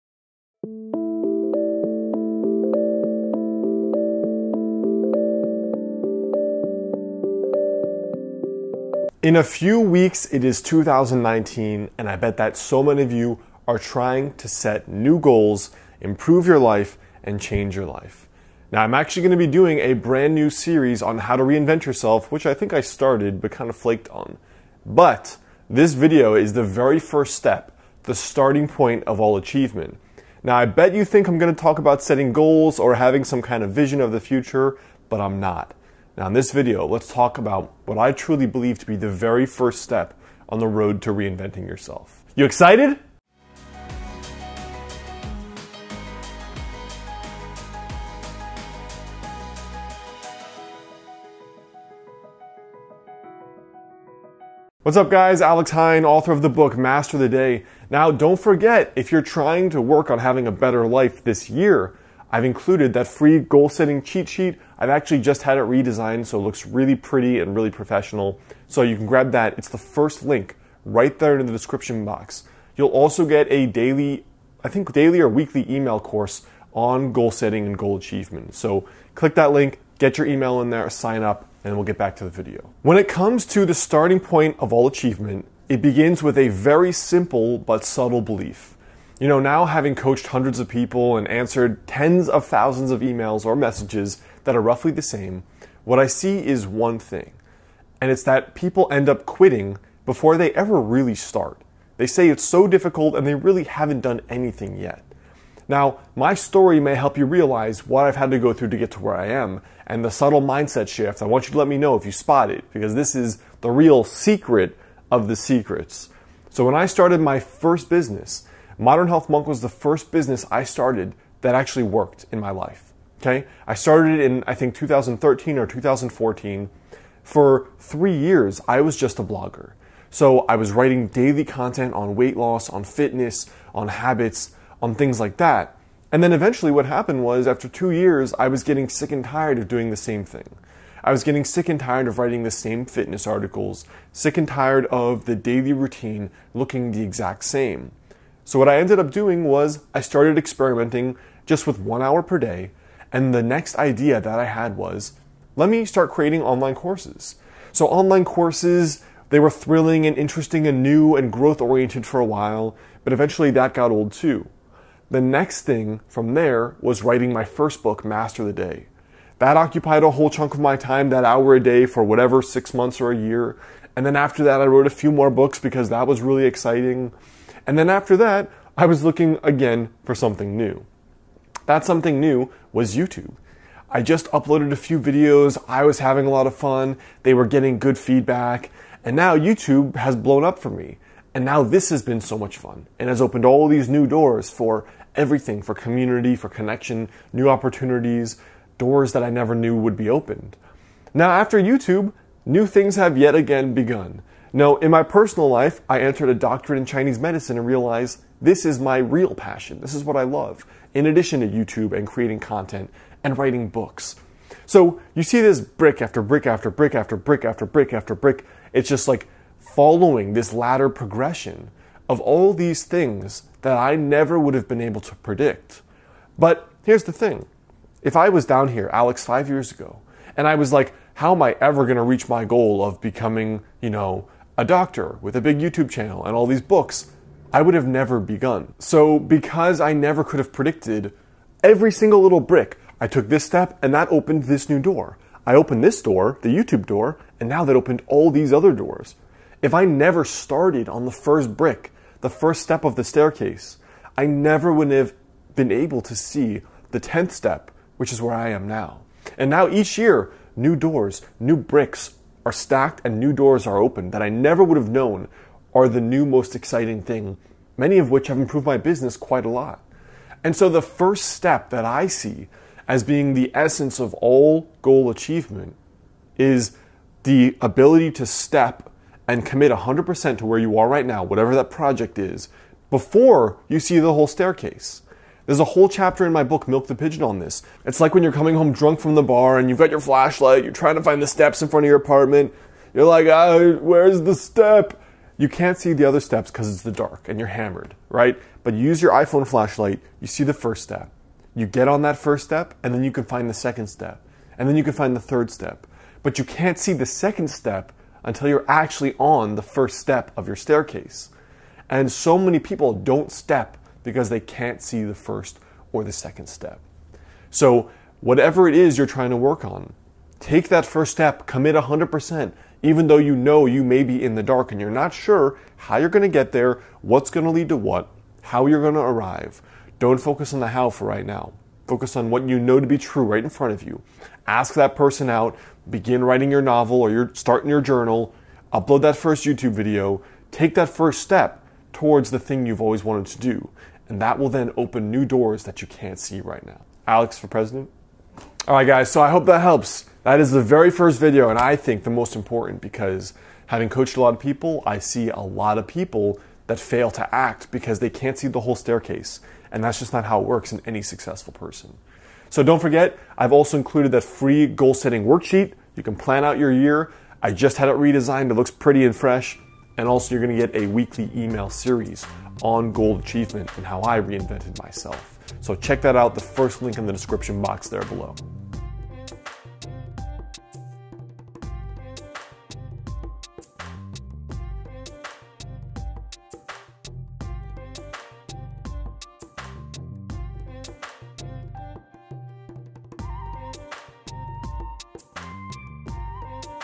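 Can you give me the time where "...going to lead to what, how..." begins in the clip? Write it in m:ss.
5:27.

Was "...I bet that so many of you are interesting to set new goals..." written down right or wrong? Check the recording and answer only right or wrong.
wrong.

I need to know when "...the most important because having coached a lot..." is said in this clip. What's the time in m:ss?
5:52.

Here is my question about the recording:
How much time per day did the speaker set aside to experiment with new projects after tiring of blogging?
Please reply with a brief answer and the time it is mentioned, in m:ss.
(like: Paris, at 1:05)
1 hour, at 2:31.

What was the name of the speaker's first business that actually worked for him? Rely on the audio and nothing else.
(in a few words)
Modern Health Monk.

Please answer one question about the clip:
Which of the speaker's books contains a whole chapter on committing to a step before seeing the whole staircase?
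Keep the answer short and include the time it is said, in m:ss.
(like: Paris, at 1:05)
Milk the Pigeon, at 4:46.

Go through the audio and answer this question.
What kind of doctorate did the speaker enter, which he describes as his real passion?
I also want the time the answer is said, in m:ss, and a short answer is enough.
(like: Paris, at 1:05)
Chinese medicine, at 3:26.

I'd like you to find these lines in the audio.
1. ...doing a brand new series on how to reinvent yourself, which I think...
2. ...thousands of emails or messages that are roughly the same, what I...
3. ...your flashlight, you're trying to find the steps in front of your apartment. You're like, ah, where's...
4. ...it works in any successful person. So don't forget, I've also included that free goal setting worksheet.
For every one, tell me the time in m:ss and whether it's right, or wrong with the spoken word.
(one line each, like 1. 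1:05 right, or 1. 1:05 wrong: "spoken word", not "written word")
1. 0:19 right
2. 1:32 right
3. 4:49 right
4. 6:00 right.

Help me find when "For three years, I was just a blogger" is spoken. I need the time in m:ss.
2:07.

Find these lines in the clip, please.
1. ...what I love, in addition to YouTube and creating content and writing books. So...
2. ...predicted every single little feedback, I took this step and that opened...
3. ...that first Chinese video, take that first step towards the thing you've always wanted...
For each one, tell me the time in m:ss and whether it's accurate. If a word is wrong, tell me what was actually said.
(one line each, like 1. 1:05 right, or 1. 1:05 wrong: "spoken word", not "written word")
1. 3:30 right
2. 4:00 wrong: "brick", not "feedback"
3. 5:39 wrong: "YouTube", not "Chinese".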